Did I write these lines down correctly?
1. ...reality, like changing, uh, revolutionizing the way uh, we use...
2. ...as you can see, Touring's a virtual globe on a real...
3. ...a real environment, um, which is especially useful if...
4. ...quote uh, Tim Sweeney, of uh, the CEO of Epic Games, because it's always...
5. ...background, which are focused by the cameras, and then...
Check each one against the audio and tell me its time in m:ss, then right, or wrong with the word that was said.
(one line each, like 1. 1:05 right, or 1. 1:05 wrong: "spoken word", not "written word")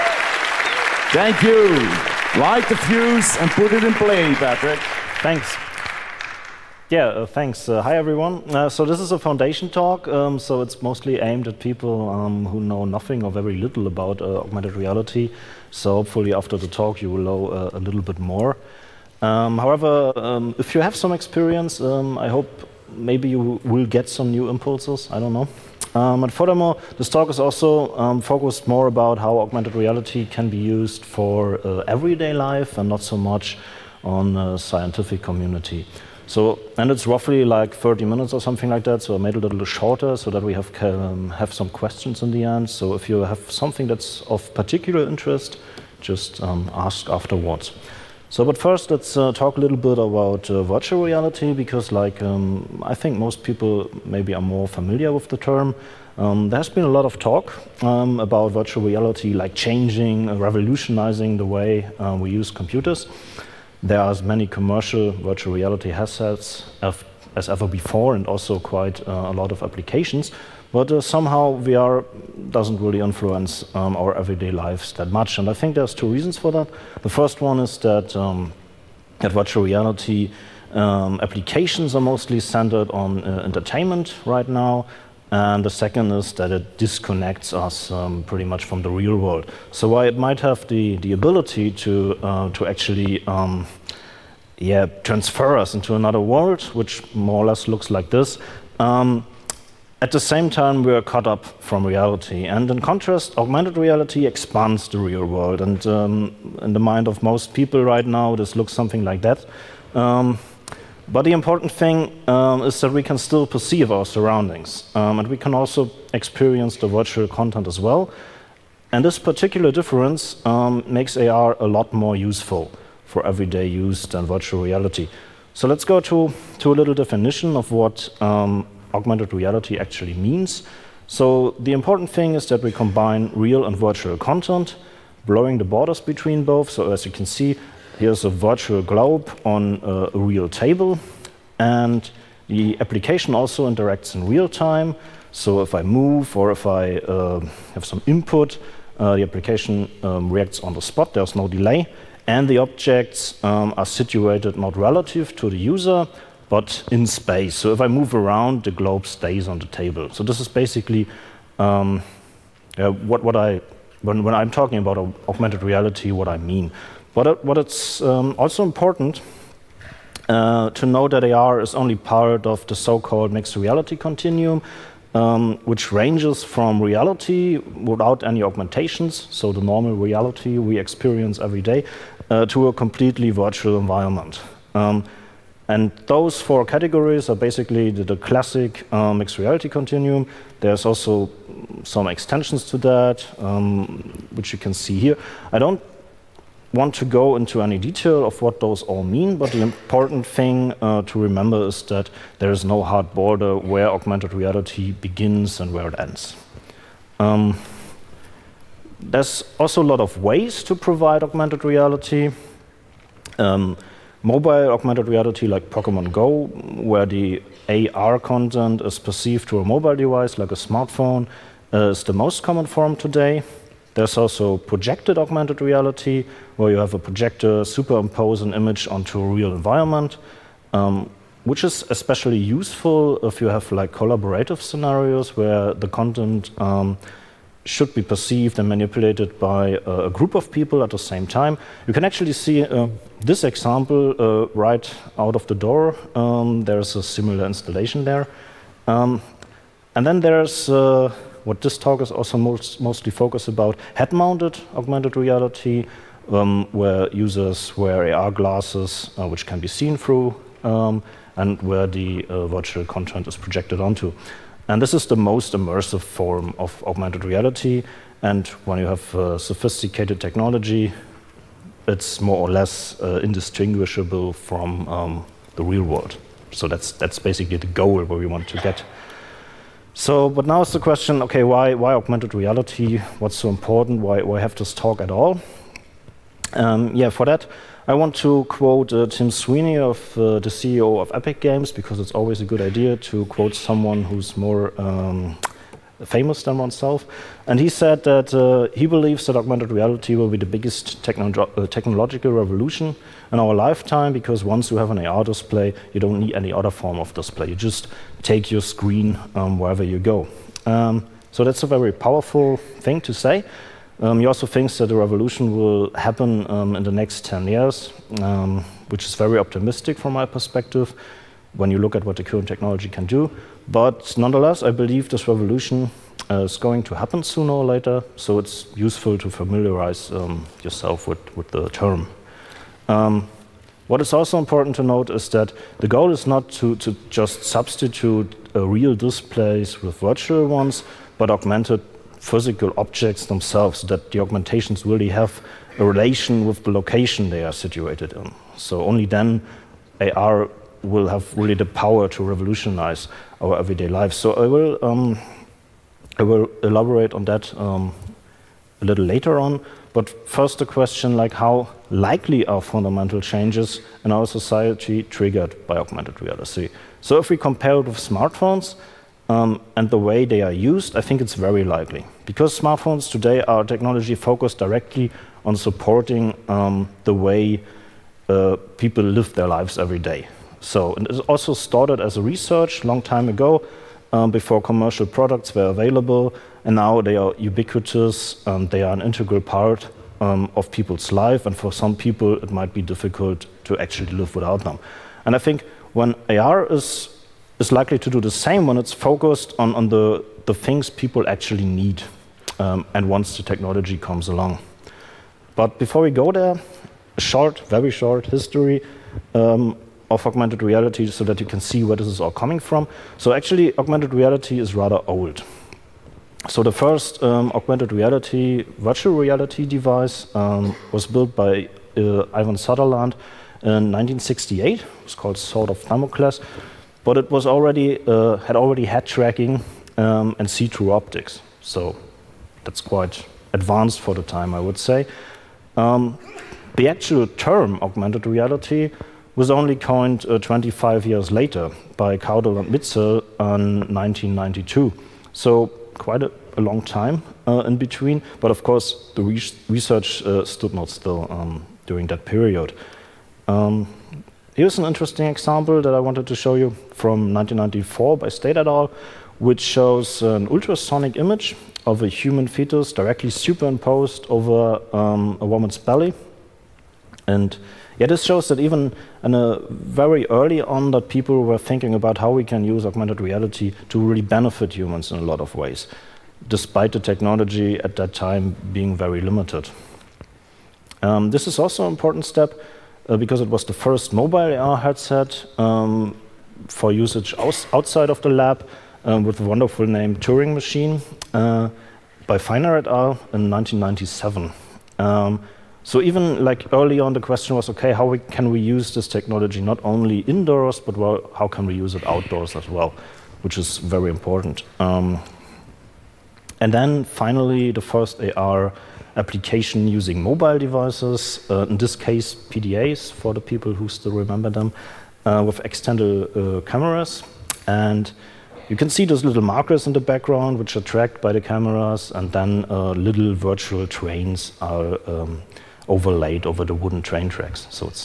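1. 0:58 right
2. 2:16 wrong: "Here", not "Touring"
3. 3:49 right
4. 4:48 right
5. 8:39 wrong: "tracked", not "focused".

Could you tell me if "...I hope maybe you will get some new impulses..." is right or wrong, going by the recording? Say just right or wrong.
right.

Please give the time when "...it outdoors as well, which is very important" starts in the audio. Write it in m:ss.
8:21.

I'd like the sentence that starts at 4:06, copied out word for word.
Um, there's a similar installation there.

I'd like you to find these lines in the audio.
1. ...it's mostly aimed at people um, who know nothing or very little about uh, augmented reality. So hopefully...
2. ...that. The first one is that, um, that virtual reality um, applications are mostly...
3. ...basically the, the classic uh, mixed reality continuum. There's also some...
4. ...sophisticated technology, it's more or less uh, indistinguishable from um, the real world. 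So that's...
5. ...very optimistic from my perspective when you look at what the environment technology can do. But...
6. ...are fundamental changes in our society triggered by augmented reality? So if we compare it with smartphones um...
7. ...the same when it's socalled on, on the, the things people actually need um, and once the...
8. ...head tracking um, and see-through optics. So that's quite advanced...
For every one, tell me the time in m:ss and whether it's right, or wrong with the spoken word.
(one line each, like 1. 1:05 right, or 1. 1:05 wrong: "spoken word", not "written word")
1. 0:10 right
2. 1:16 right
3. 3:07 right
4. 4:29 right
5. 5:19 wrong: "current", not "environment"
6. 6:02 right
7. 6:38 wrong: "focused", not "socalled"
8. 7:08 right.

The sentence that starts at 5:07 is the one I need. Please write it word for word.
You just take your screen um, wherever you go.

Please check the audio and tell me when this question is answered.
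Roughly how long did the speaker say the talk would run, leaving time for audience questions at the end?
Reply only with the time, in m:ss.
0:37.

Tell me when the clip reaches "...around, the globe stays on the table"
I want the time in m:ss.
2:38.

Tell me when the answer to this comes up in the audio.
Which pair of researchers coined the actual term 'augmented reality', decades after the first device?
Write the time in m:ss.
7:22.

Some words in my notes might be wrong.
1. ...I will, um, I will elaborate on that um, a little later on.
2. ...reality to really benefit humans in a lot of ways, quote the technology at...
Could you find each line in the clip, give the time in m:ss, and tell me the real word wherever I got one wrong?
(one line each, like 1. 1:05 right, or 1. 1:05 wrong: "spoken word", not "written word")
1. 5:54 right
2. 7:53 wrong: "despite", not "quote".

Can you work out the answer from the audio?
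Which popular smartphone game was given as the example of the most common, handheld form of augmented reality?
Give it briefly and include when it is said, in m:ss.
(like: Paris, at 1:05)
Pokemon Go, at 3:35.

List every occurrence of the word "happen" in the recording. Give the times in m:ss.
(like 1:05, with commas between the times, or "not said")
5:15, 5:26.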